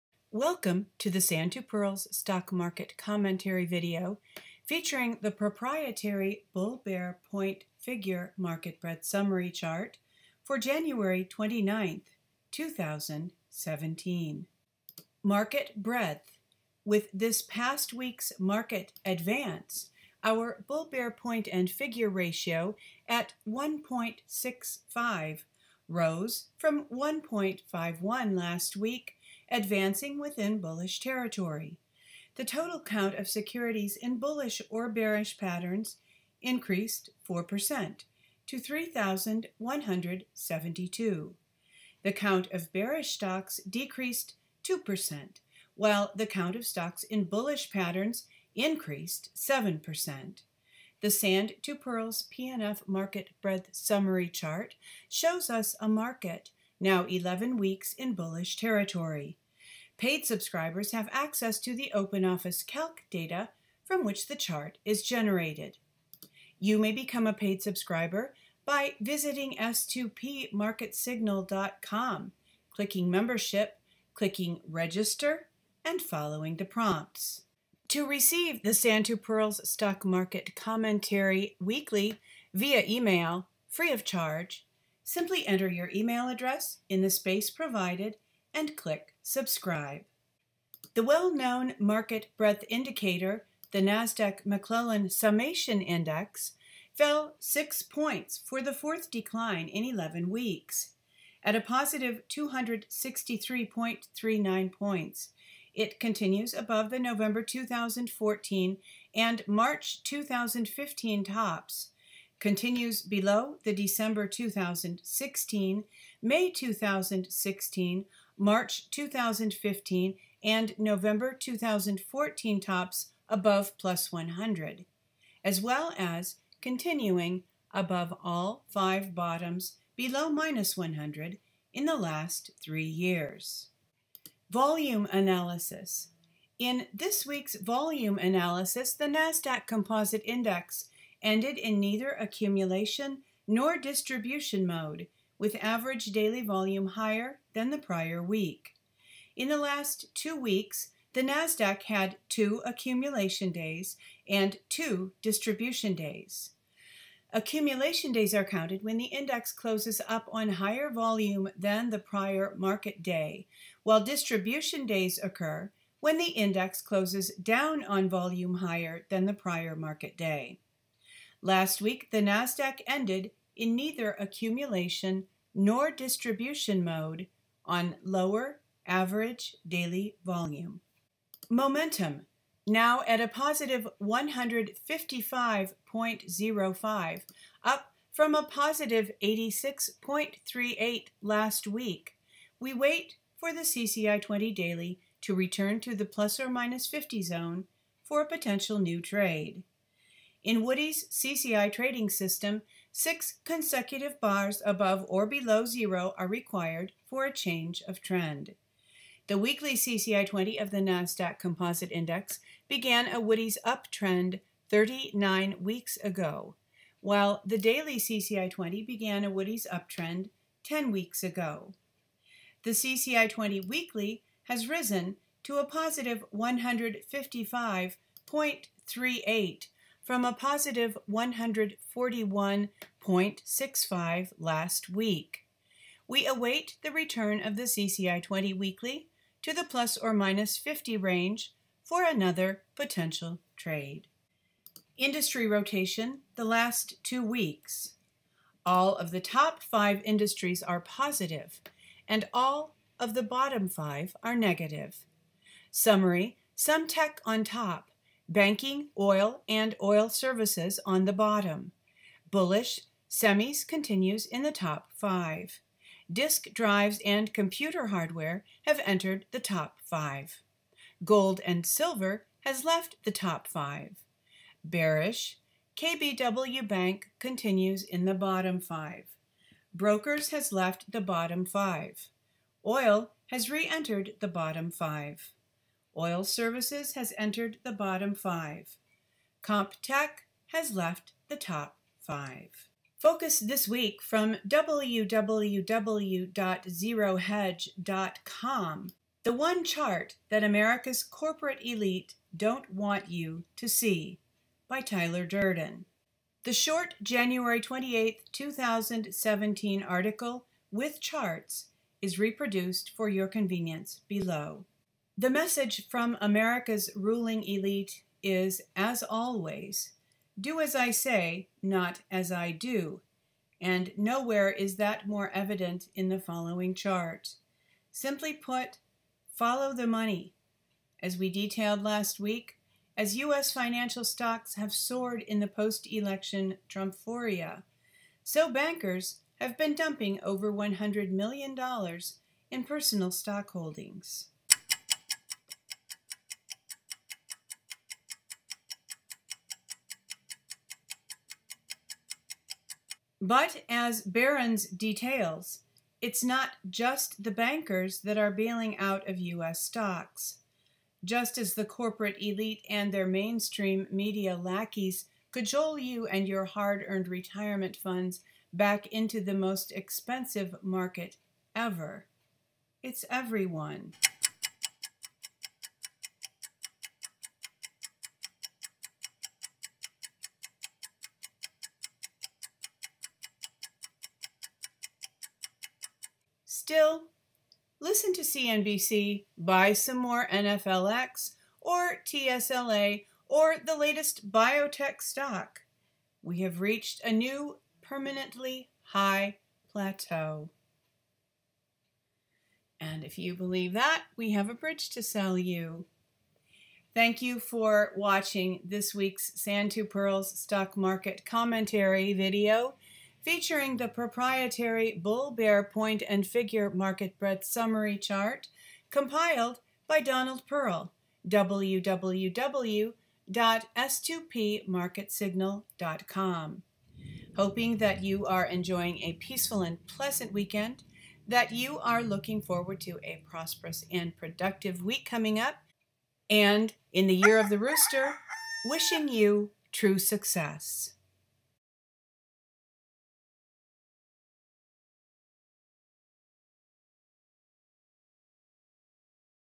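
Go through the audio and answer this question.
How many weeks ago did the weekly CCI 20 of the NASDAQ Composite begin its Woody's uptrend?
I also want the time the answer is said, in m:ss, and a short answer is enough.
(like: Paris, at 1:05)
39, at 3:34.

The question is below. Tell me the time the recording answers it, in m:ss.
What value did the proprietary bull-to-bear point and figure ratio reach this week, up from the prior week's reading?
0:23.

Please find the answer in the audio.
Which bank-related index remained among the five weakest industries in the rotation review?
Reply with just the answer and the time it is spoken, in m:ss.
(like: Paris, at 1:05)
KBW Bank, at 4:35.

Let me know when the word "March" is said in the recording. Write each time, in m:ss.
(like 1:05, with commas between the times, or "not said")
1:49, 1:58.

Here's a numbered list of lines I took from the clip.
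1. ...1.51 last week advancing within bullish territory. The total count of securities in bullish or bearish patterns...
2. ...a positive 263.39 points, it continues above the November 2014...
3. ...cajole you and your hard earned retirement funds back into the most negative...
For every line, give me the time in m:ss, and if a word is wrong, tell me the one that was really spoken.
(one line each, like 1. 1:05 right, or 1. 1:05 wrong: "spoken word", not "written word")
1. 0:26 right
2. 1:41 right
3. 6:05 wrong: "expensive", not "negative".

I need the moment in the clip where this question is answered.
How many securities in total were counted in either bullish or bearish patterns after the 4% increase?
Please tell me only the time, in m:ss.
0:38.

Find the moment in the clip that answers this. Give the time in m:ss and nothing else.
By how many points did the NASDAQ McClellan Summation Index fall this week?
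1:37.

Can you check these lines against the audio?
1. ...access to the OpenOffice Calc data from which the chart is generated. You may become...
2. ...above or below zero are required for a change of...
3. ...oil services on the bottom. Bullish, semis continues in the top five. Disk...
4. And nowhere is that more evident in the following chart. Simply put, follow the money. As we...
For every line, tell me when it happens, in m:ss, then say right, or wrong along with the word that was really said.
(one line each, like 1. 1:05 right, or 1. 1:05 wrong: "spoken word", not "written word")
1. 1:01 right
2. 3:24 right
3. 4:19 right
4. 5:23 right.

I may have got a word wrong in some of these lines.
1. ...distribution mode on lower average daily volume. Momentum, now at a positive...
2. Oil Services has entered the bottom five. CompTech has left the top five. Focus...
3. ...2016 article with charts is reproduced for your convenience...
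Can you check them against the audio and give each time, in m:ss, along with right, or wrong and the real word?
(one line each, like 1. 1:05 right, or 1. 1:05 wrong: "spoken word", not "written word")
1. 2:55 right
2. 4:45 right
3. 5:08 wrong: "2017", not "2016".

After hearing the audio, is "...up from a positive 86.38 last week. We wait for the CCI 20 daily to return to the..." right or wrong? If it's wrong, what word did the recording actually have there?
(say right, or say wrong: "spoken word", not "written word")
right.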